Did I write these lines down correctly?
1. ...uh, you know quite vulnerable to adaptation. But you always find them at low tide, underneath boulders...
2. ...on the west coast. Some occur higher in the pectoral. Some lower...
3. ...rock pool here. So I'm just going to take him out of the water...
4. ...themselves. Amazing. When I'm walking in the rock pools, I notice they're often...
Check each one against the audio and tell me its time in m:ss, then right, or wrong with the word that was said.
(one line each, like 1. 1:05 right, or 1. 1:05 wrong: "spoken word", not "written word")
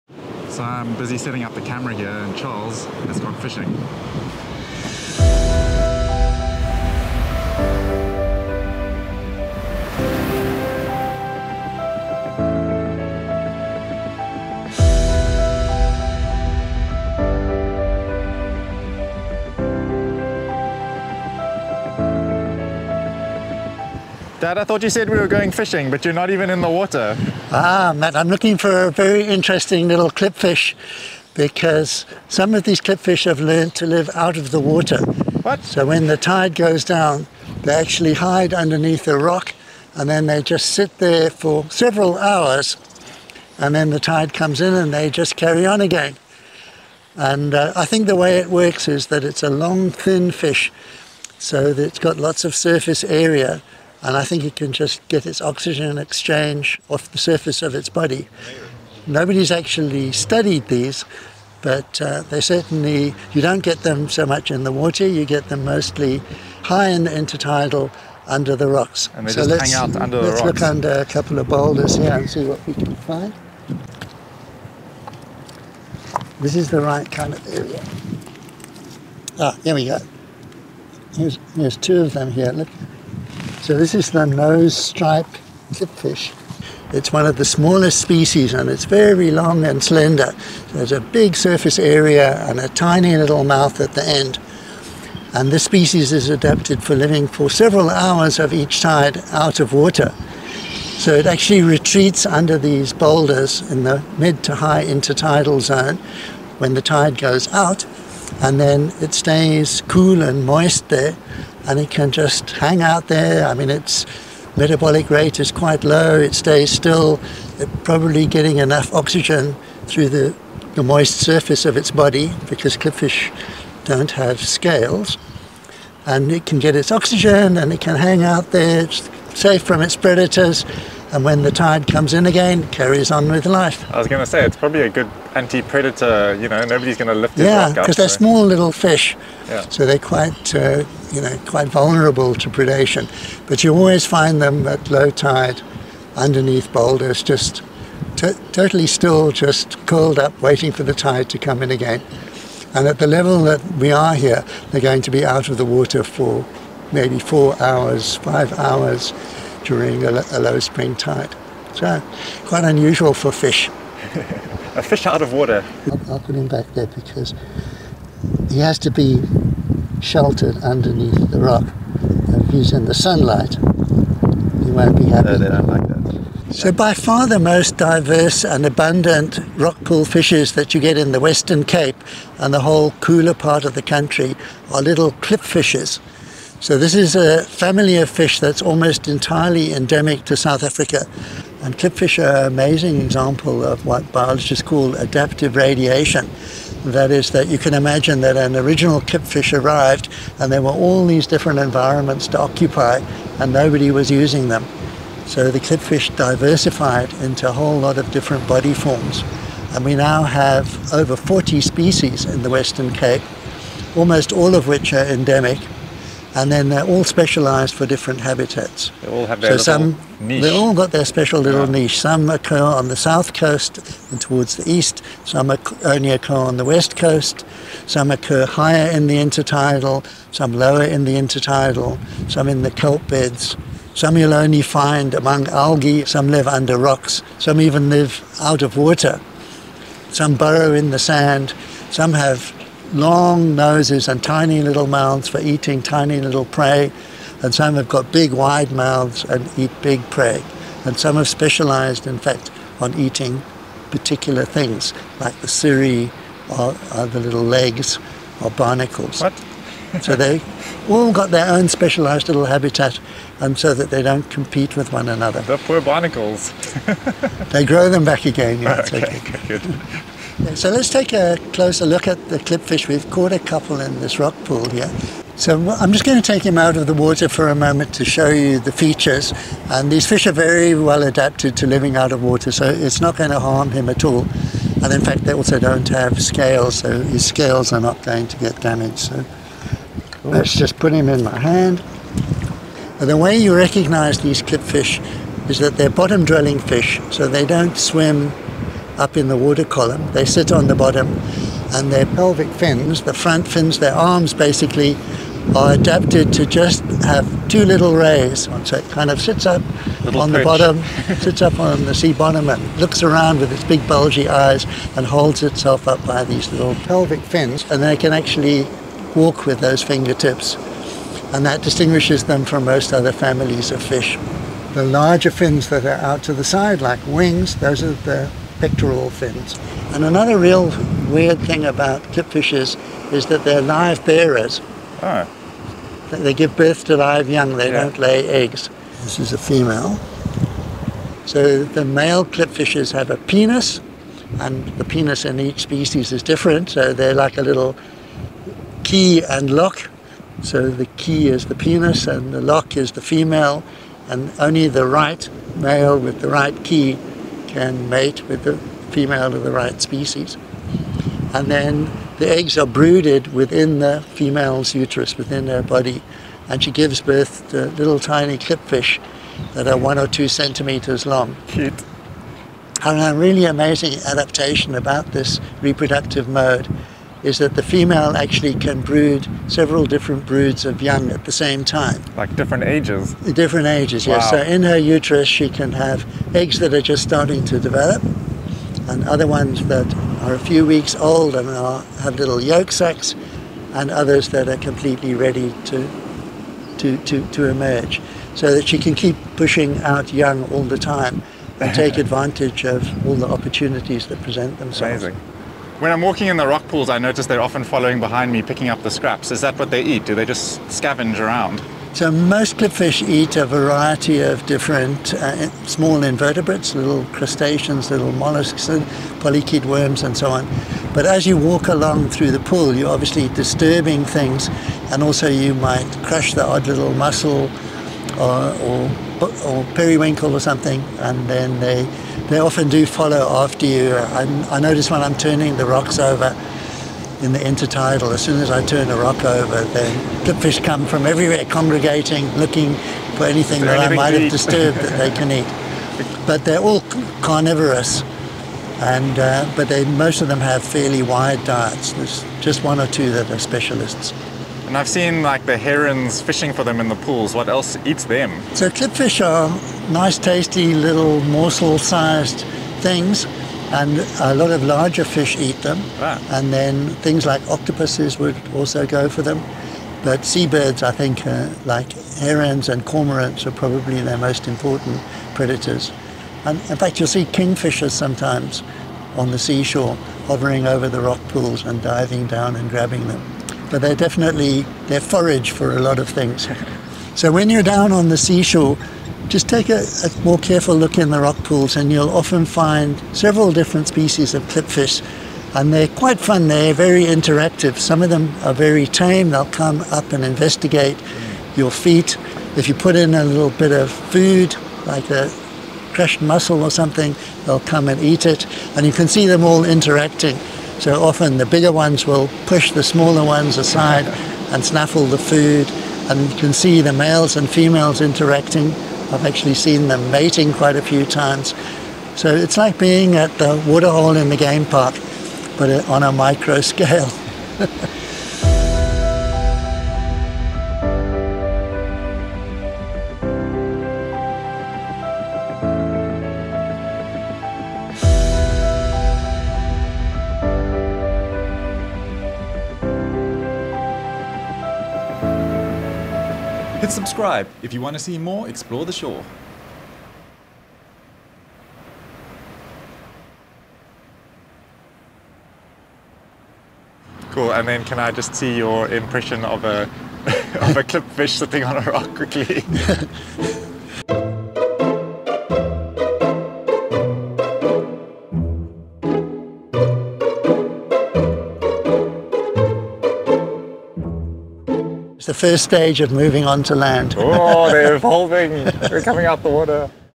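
1. 2:20 wrong: "predation", not "adaptation"
2. 3:46 wrong: "intertidal", not "pectoral"
3. 4:34 right
4. 6:44 right.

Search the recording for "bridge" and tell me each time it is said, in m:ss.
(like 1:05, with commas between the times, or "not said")
not said.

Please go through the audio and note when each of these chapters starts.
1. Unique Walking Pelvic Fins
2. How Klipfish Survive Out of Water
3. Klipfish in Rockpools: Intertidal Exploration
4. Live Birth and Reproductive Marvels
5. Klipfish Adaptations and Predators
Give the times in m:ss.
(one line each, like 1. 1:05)
1. 2:35
2. 0:34
3. 5:17
4. 3:50
5. 1:48.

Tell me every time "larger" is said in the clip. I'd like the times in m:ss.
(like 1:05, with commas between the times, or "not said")
5:24, 7:44.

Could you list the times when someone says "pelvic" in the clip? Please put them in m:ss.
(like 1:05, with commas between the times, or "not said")
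5:02, 5:16.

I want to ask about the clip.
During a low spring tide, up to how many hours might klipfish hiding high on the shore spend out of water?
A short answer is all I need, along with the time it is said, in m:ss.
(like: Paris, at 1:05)
5 hours, at 2:38.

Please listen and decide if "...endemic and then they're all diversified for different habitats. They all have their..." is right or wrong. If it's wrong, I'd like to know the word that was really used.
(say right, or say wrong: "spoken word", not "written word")
wrong: "specialised", not "diversified".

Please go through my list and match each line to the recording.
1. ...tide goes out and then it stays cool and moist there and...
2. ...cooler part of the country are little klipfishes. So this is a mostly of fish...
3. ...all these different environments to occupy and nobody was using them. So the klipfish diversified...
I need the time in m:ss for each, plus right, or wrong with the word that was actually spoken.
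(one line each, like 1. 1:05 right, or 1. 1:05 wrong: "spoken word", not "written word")
1. 1:46 right
2. 3:02 wrong: "family", not "mostly"
3. 3:20 right.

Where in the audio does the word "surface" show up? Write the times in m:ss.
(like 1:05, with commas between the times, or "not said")
0:52, 0:57, 1:31, 2:01.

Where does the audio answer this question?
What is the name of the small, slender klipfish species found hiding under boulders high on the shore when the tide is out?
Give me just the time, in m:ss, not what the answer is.
1:24.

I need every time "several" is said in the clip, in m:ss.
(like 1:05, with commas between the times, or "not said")
0:41, 1:37, 6:19, 8:13.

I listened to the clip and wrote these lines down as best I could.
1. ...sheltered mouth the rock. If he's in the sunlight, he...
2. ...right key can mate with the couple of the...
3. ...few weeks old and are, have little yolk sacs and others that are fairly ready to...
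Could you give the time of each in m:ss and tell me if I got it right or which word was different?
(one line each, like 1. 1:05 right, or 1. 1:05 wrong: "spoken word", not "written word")
1. 2:50 wrong: "underneath", not "mouth"
2. 5:56 wrong: "female", not "couple"
3. 6:30 wrong: "completely", not "fairly".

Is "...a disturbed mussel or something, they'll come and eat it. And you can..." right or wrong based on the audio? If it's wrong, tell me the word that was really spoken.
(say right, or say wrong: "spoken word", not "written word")
wrong: "crushed", not "disturbed".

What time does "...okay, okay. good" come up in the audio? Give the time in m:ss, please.
4:28.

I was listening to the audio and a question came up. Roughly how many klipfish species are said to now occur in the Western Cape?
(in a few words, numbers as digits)
over 40.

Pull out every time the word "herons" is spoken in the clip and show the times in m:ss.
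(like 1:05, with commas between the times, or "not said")
7:35, 7:52.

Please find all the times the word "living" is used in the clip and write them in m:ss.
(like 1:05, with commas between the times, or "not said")
1:36, 4:41.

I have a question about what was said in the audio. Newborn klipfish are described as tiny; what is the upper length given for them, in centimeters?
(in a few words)
2 centimeters.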